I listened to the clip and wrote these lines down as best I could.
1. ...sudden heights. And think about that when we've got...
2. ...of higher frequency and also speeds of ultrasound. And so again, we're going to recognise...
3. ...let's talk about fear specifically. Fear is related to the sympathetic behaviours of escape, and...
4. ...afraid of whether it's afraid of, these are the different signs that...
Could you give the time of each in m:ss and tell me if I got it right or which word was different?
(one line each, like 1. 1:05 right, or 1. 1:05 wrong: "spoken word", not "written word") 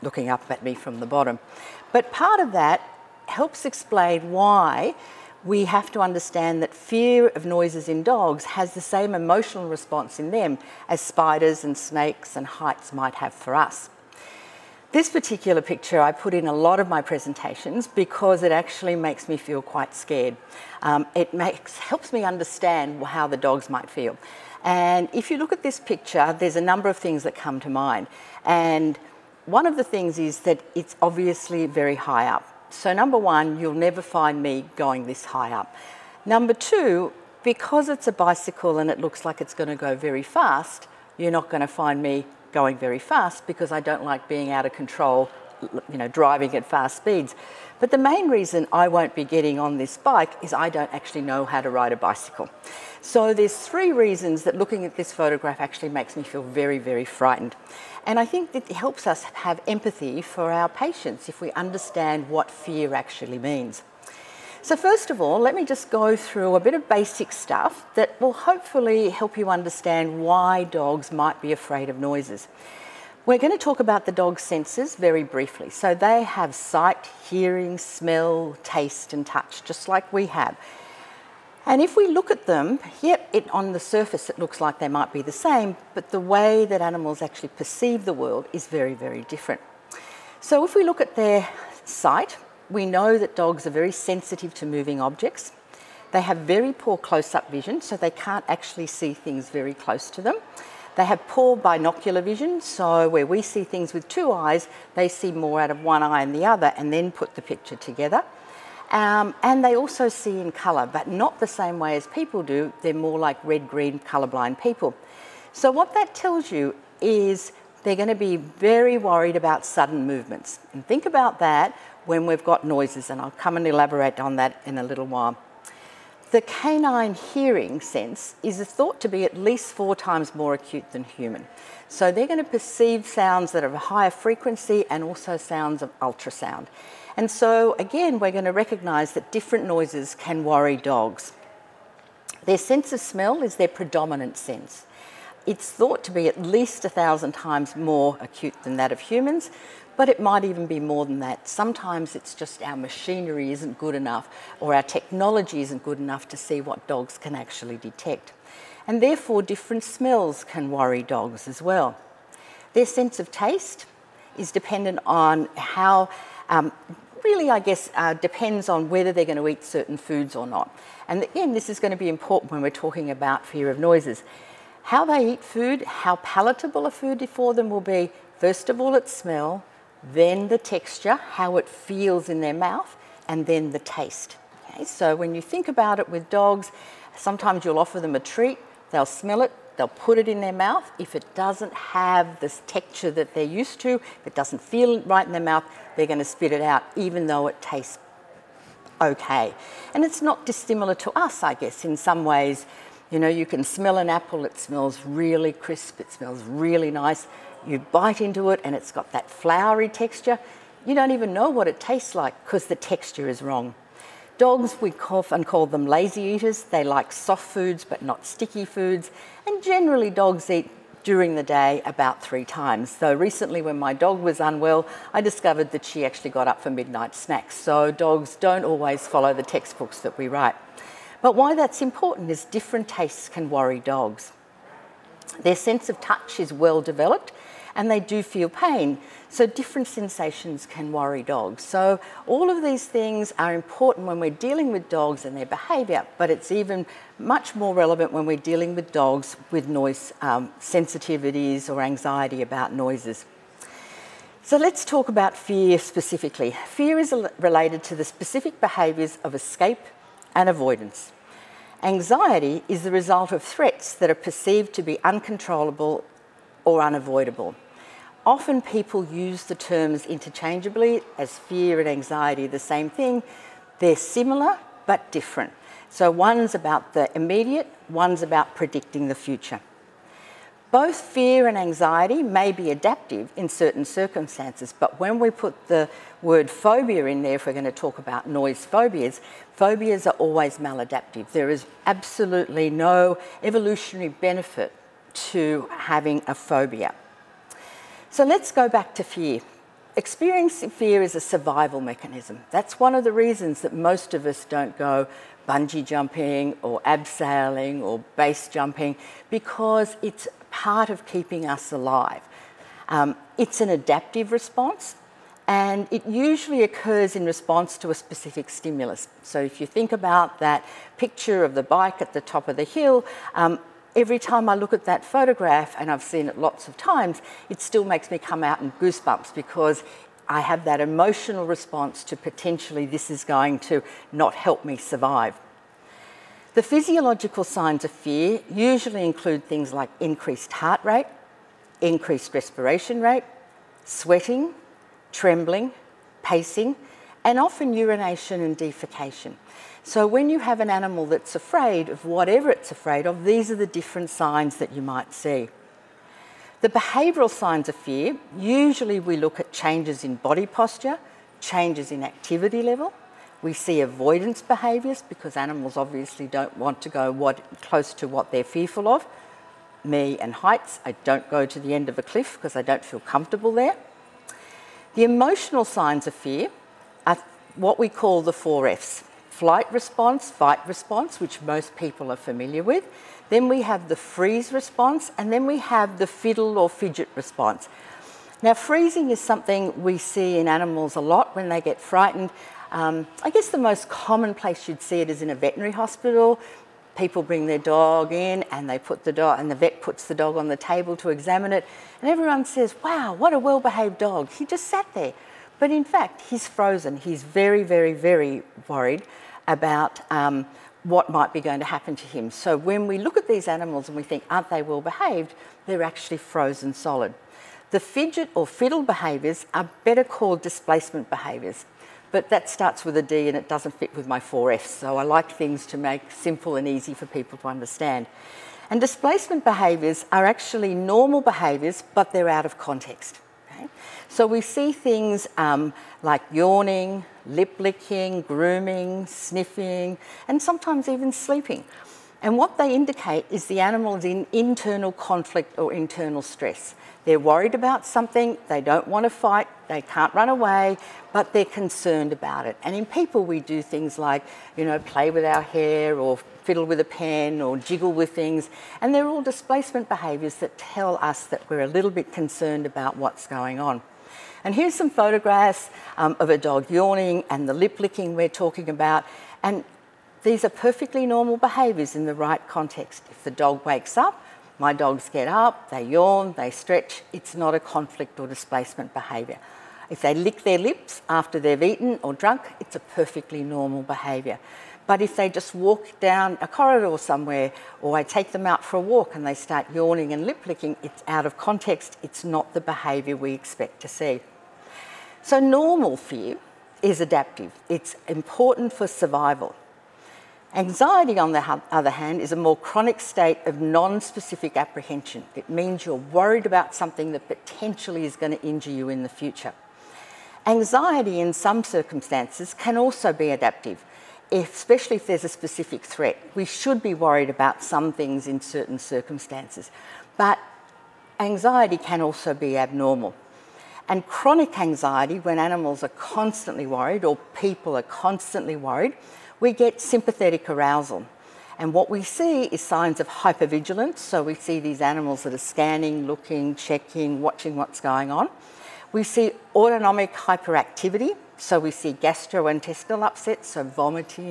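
1. 1:59 wrong: "movements", not "heights"
2. 2:13 wrong: "sounds", not "speeds"
3. 4:14 wrong: "specific", not "sympathetic"
4. 5:51 wrong: "whatever", not "whether".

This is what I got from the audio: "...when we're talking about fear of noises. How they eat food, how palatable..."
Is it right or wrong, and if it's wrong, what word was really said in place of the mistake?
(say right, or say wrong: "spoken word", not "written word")
right.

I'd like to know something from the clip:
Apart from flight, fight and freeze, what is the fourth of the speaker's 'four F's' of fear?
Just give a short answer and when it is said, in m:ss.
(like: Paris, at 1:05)
Fiddle or fidget, at 6:26.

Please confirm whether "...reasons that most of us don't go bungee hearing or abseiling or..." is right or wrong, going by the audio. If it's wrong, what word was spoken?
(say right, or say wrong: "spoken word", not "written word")
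wrong: "jumping", not "hearing".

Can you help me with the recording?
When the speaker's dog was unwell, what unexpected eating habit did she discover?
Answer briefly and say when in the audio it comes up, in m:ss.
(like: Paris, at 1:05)
Midnight snacks, at 3:46.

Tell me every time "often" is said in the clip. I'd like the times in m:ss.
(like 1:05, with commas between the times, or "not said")
3:35, 4:28, 5:47.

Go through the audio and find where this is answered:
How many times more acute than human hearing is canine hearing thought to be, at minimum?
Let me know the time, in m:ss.
2:09.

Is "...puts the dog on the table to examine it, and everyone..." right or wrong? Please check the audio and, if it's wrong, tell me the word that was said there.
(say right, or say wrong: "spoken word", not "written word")
right.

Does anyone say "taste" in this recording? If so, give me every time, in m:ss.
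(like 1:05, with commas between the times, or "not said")
1:18, 2:43, 3:03, 3:17, 3:31, 3:52.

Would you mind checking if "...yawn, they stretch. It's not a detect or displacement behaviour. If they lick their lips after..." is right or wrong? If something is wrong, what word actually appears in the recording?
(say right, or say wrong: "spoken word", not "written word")
wrong: "conflict", not "detect".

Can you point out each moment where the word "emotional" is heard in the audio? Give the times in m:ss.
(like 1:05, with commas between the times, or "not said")
0:09, 5:30, 6:15.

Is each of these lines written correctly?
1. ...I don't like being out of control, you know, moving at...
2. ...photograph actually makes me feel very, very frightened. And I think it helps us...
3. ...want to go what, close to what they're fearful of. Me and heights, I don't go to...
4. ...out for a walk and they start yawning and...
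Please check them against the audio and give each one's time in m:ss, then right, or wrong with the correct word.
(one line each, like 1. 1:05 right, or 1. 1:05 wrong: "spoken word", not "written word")
1. 0:43 wrong: "driving", not "moving"
2. 0:55 right
3. 6:06 right
4. 8:08 right.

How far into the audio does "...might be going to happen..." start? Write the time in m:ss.
6:51.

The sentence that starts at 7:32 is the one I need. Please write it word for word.
And in people, we do things like, you know, play with our hair or fiddle with a pen or jiggle with things.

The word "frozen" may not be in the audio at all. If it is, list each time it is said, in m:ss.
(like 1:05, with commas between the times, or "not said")
6:46, 6:56.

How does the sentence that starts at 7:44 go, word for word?
And here's some photographs um, of a dog yawning and the lip licking we're talking about.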